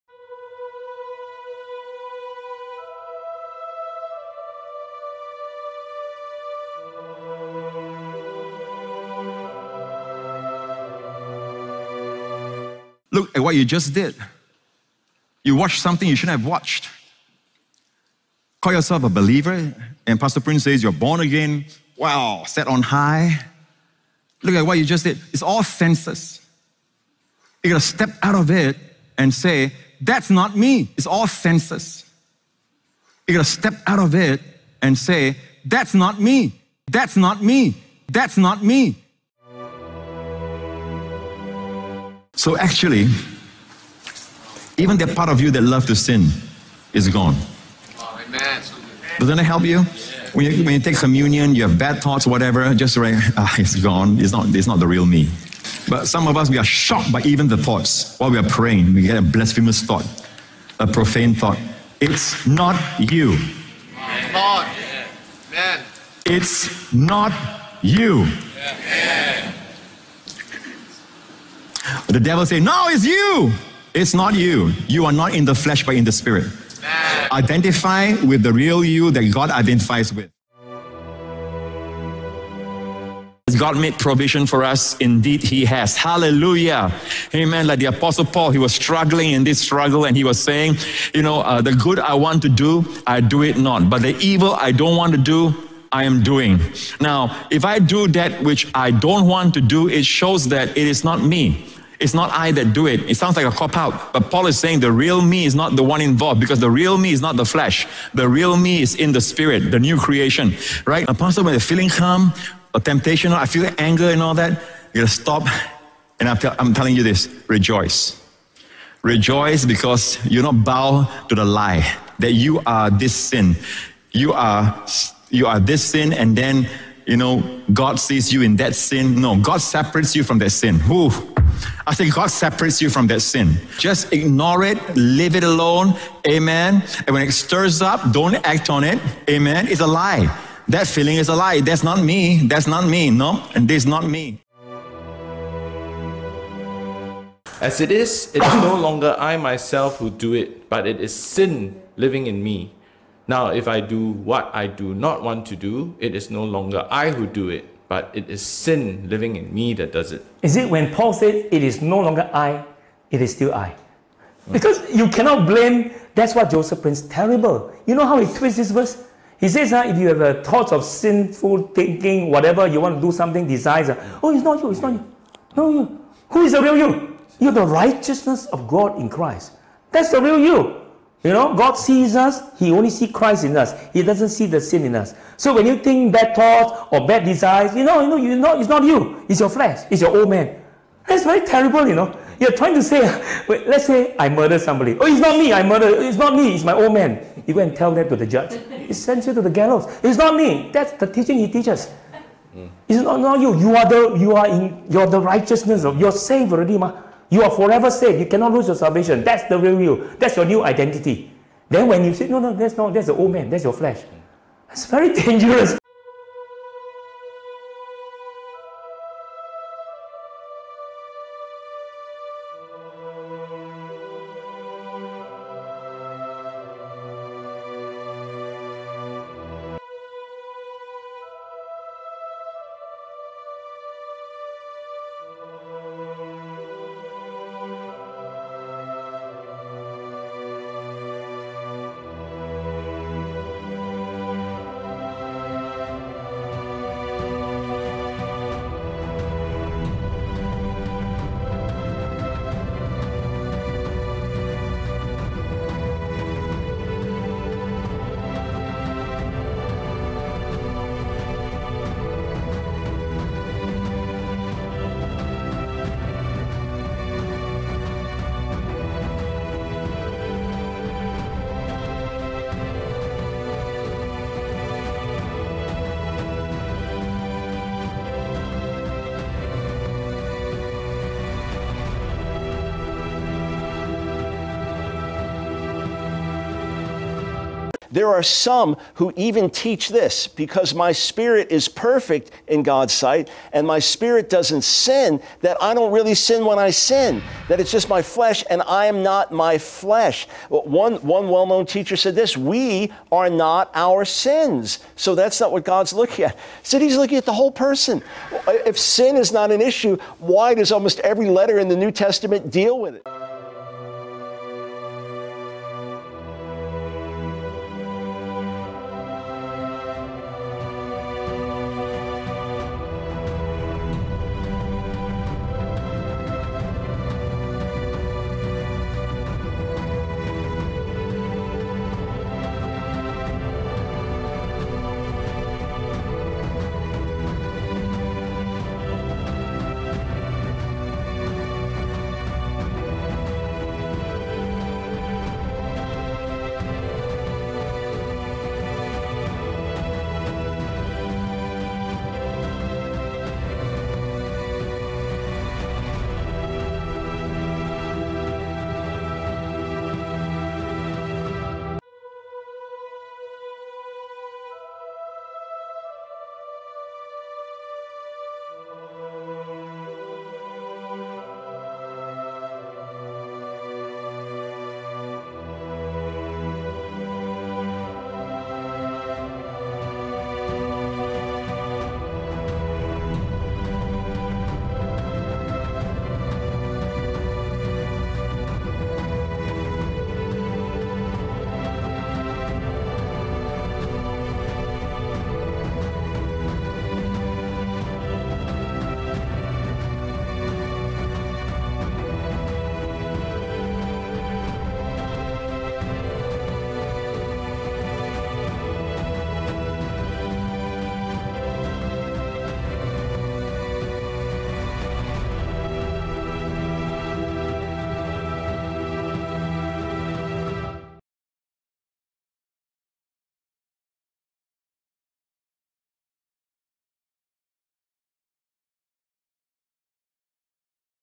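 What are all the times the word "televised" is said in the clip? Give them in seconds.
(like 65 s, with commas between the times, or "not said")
not said.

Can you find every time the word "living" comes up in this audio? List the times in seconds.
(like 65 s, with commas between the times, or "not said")
151 s, 159 s.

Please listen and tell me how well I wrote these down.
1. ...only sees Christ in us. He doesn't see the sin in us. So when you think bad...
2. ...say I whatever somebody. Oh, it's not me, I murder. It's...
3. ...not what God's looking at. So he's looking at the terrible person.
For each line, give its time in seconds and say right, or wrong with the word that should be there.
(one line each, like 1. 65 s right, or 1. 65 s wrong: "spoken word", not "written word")
1. 182 s right
2. 193 s wrong: "murder", not "whatever"
3. 305 s wrong: "whole", not "terrible".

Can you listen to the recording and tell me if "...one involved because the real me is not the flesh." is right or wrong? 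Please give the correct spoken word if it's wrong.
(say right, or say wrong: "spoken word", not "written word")
right.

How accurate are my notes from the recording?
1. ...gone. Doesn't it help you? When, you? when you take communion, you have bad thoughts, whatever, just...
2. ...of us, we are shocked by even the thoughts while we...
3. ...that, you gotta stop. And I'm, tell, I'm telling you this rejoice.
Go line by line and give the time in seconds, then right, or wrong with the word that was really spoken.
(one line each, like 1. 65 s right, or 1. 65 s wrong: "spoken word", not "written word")
1. 47 s right
2. 56 s right
3. 114 s right.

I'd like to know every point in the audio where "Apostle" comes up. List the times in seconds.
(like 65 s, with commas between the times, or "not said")
87 s, 111 s.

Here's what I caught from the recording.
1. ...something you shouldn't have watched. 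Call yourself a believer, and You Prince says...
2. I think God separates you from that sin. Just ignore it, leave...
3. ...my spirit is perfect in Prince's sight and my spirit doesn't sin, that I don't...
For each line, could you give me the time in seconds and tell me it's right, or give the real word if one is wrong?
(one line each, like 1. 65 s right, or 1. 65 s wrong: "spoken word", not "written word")
1. 15 s wrong: "Pastor", not "You"
2. 131 s right
3. 290 s wrong: "God", not "Prince".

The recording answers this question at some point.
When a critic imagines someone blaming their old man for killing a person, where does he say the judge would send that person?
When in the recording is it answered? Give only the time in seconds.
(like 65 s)
199 s.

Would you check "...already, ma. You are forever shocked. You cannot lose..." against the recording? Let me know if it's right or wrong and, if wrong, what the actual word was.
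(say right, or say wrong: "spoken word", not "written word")
wrong: "saved", not "shocked".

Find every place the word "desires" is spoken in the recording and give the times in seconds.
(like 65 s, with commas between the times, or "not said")
173 s, 187 s.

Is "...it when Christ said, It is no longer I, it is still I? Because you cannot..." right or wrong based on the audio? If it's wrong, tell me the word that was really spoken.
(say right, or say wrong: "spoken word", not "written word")
wrong: "Paul", not "Christ".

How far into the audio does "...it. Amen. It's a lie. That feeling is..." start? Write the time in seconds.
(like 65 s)
138 s.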